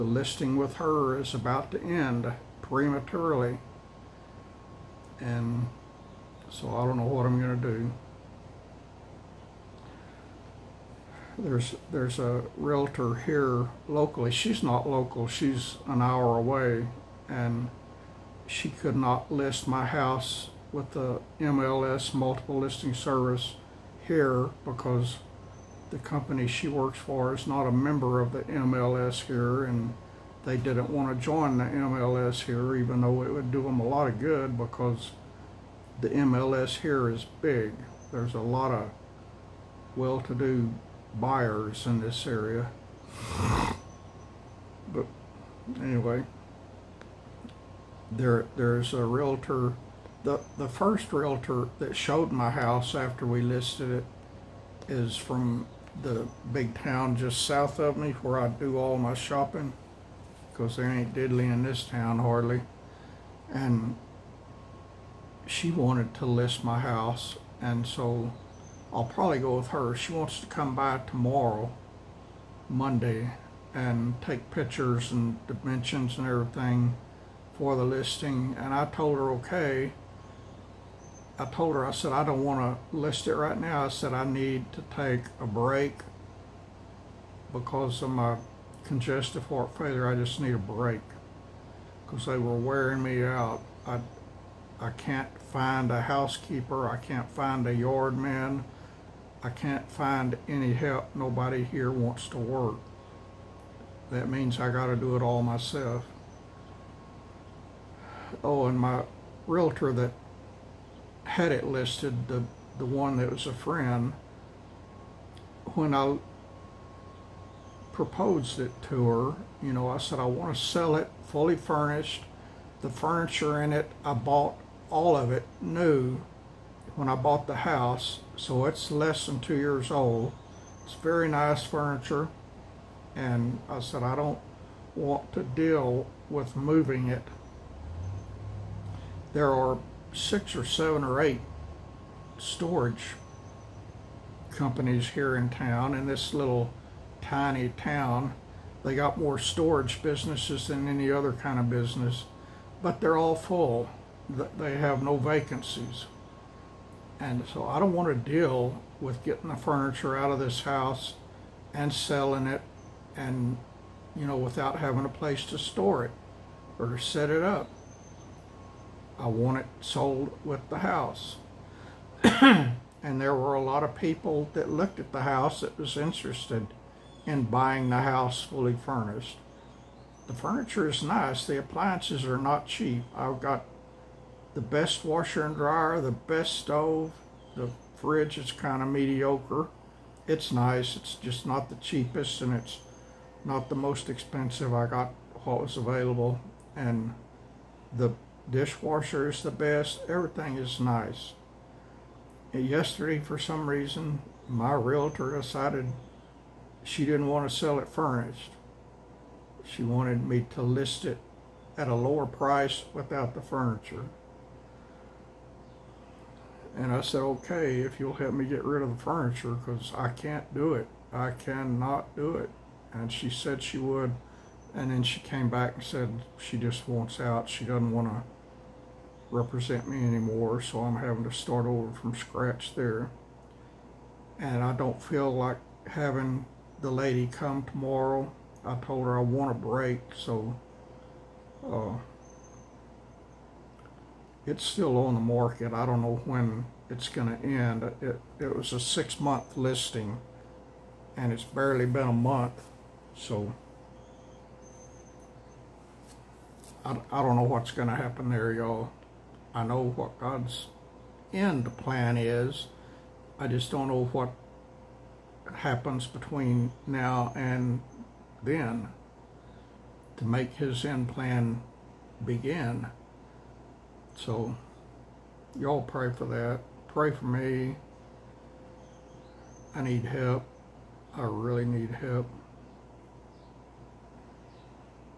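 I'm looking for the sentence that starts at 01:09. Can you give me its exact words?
She wants to come by tomorrow, Monday, and take pictures and dimensions and everything for the listing.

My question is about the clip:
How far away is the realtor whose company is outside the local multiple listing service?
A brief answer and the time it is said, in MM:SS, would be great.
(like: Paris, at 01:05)
an hour, at 00:15.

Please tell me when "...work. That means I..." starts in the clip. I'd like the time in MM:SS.
01:42.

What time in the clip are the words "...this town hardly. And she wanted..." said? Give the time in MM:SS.
01:01.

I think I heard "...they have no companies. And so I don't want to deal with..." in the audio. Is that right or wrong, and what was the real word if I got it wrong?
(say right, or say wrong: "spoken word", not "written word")
wrong: "vacancies", not "companies".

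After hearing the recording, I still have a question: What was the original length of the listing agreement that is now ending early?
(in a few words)
6 months.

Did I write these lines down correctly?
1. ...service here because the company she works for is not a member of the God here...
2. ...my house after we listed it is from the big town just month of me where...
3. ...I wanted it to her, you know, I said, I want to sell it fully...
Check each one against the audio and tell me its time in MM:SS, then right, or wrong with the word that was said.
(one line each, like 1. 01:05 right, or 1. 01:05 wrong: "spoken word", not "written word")
1. 00:22 wrong: "MLS", not "God"
2. 00:52 wrong: "south", not "month"
3. 01:55 wrong: "proposed", not "wanted".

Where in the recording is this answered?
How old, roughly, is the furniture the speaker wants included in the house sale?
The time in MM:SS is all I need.
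02:08.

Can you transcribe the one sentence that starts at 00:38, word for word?
There's a lot of well-to-do buyers in this area.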